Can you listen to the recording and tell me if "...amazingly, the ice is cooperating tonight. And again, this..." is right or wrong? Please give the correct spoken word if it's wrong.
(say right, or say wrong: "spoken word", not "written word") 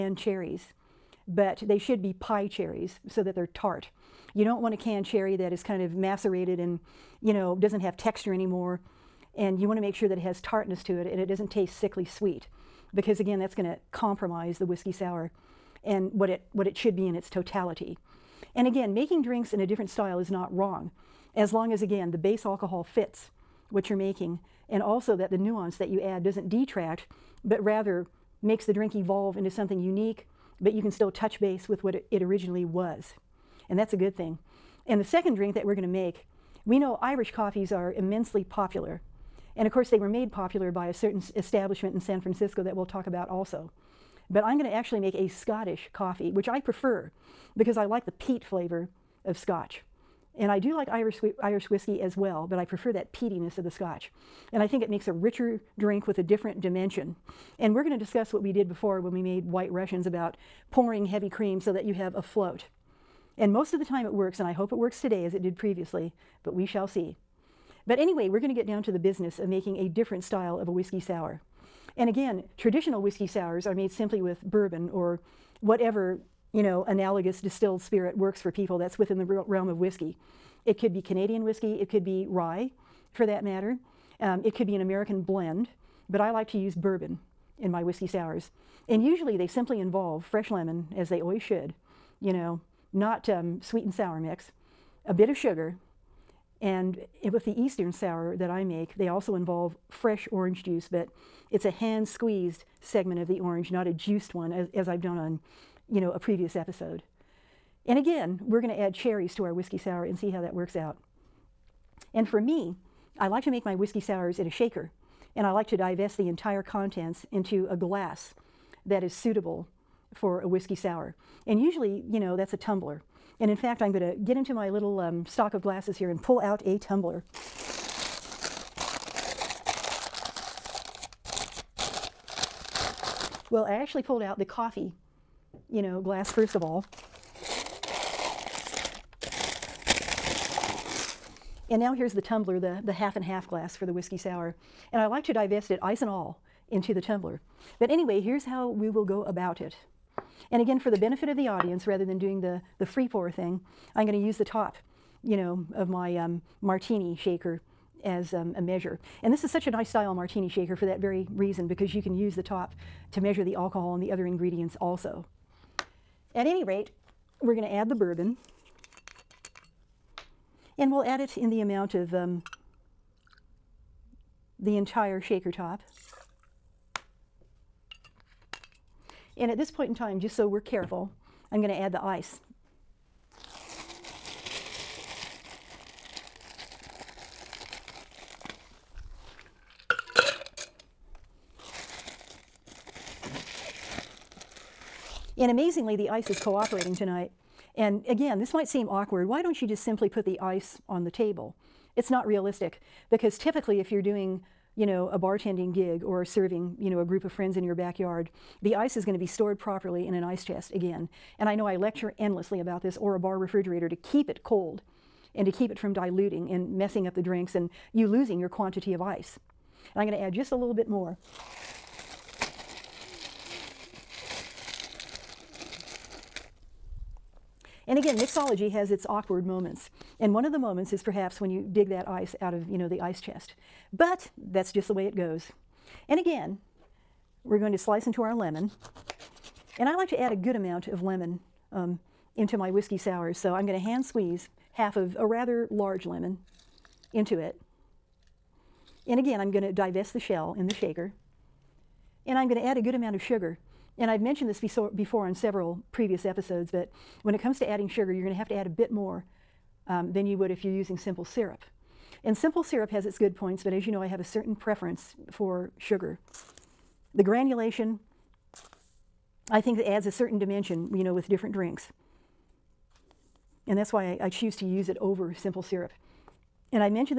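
right.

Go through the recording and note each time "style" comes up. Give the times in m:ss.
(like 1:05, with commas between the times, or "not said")
0:19, 1:10, 2:39.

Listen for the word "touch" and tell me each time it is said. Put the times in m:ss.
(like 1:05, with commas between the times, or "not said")
0:31.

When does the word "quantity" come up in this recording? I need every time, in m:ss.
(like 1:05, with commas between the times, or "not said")
3:38.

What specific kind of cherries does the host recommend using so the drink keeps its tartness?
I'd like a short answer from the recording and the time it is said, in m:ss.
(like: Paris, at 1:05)
pie cherries, at 0:02.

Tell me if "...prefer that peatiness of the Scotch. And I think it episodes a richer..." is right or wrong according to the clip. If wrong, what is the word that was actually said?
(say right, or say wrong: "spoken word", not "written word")
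wrong: "makes", not "episodes".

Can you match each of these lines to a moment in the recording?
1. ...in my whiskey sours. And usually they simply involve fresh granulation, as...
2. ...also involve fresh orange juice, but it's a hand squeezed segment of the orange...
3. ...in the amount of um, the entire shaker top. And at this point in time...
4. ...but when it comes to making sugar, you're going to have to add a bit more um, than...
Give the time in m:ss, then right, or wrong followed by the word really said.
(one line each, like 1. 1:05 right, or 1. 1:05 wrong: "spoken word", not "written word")
1. 1:27 wrong: "lemon", not "granulation"
2. 1:39 right
3. 2:51 right
4. 4:16 wrong: "adding", not "making".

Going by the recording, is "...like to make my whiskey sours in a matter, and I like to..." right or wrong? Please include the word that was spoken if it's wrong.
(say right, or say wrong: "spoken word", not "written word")
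wrong: "shaker", not "matter".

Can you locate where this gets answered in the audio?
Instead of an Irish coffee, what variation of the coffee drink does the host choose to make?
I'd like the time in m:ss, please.
0:45.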